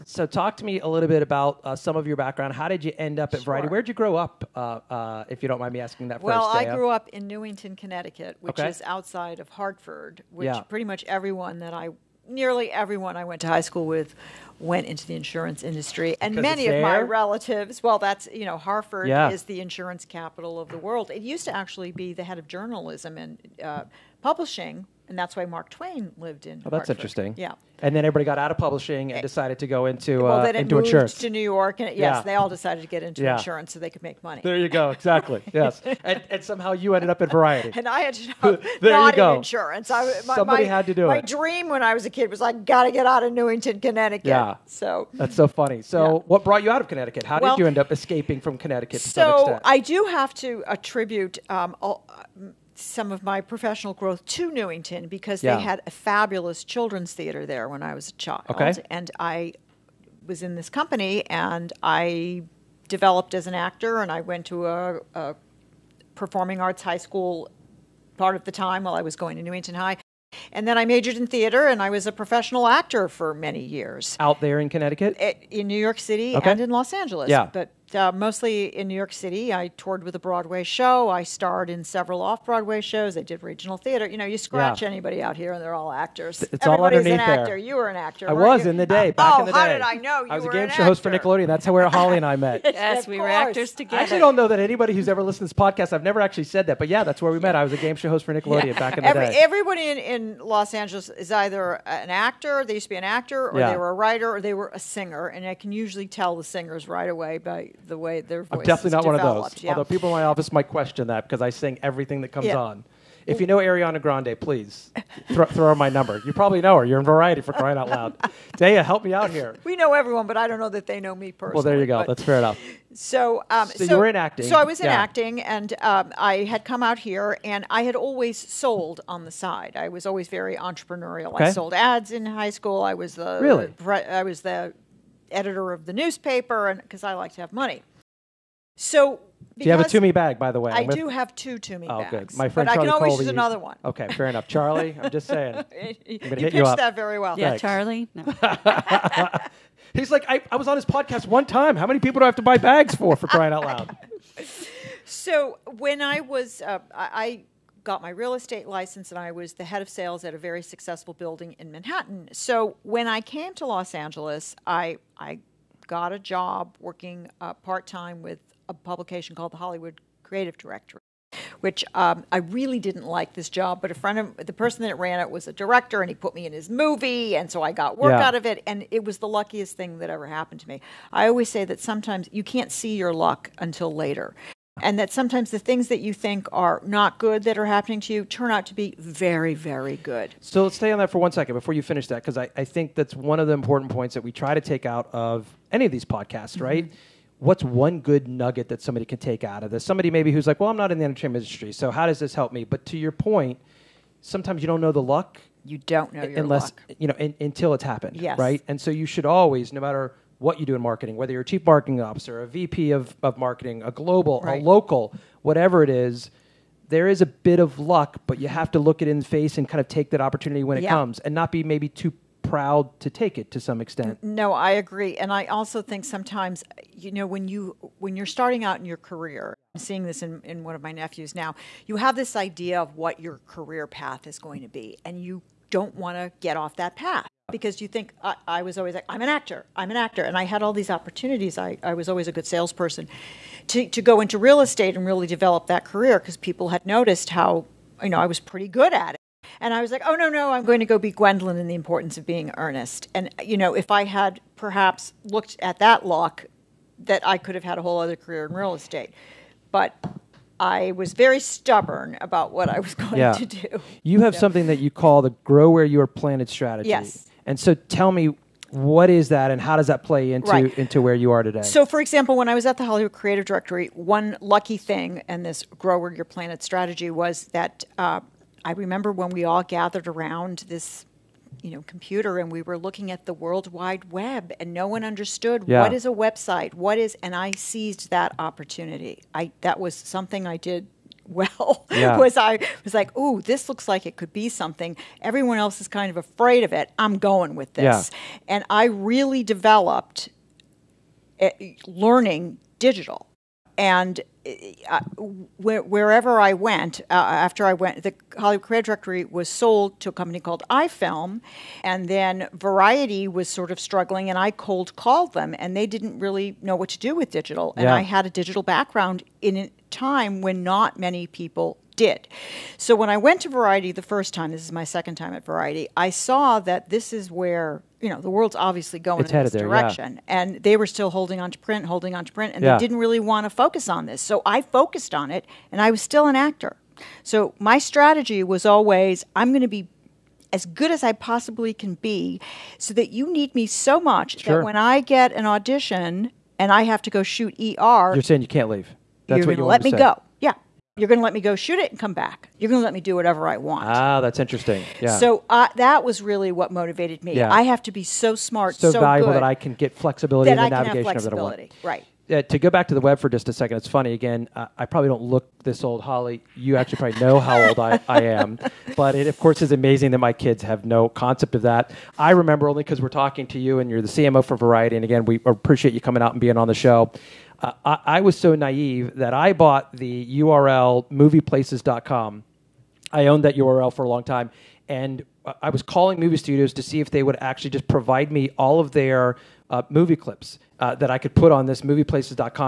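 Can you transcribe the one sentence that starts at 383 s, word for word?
I owned that URL for a long time.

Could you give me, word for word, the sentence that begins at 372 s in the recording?
I remember only because we're talking to you and you're the CMO for Variety.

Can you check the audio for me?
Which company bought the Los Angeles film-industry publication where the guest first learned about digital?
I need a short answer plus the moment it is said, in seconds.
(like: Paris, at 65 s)
iFilm, at 310 s.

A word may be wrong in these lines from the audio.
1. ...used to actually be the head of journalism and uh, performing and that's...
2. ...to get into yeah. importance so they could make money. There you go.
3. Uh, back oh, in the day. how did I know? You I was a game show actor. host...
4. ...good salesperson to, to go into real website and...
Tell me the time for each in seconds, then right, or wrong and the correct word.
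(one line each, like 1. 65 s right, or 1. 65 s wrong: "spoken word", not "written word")
1. 21 s wrong: "publishing", not "performing"
2. 32 s wrong: "insurance", not "importance"
3. 89 s right
4. 242 s wrong: "estate", not "website".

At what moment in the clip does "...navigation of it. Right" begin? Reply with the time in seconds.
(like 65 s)
360 s.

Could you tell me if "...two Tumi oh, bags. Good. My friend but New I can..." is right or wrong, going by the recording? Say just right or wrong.
wrong.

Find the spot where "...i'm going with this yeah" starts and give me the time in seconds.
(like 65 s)
296 s.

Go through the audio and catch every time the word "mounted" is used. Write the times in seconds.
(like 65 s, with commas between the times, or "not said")
not said.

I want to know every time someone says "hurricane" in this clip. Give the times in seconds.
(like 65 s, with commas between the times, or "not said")
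not said.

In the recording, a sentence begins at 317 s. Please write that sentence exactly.
I had a digital background in a time when not many people did.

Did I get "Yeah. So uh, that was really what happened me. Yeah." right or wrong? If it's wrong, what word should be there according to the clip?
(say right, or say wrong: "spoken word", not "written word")
wrong: "motivated", not "happened".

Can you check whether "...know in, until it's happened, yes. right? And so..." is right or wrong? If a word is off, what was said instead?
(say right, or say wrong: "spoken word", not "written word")
right.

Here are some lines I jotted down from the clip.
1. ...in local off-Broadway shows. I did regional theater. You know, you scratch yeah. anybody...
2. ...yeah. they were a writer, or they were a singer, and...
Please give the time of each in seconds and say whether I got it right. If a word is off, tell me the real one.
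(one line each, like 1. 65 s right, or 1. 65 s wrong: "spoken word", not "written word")
1. 81 s wrong: "several", not "local"
2. 103 s right.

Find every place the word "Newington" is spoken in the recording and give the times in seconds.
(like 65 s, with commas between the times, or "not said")
7 s, 43 s, 54 s, 69 s.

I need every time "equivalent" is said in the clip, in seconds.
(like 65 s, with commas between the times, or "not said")
not said.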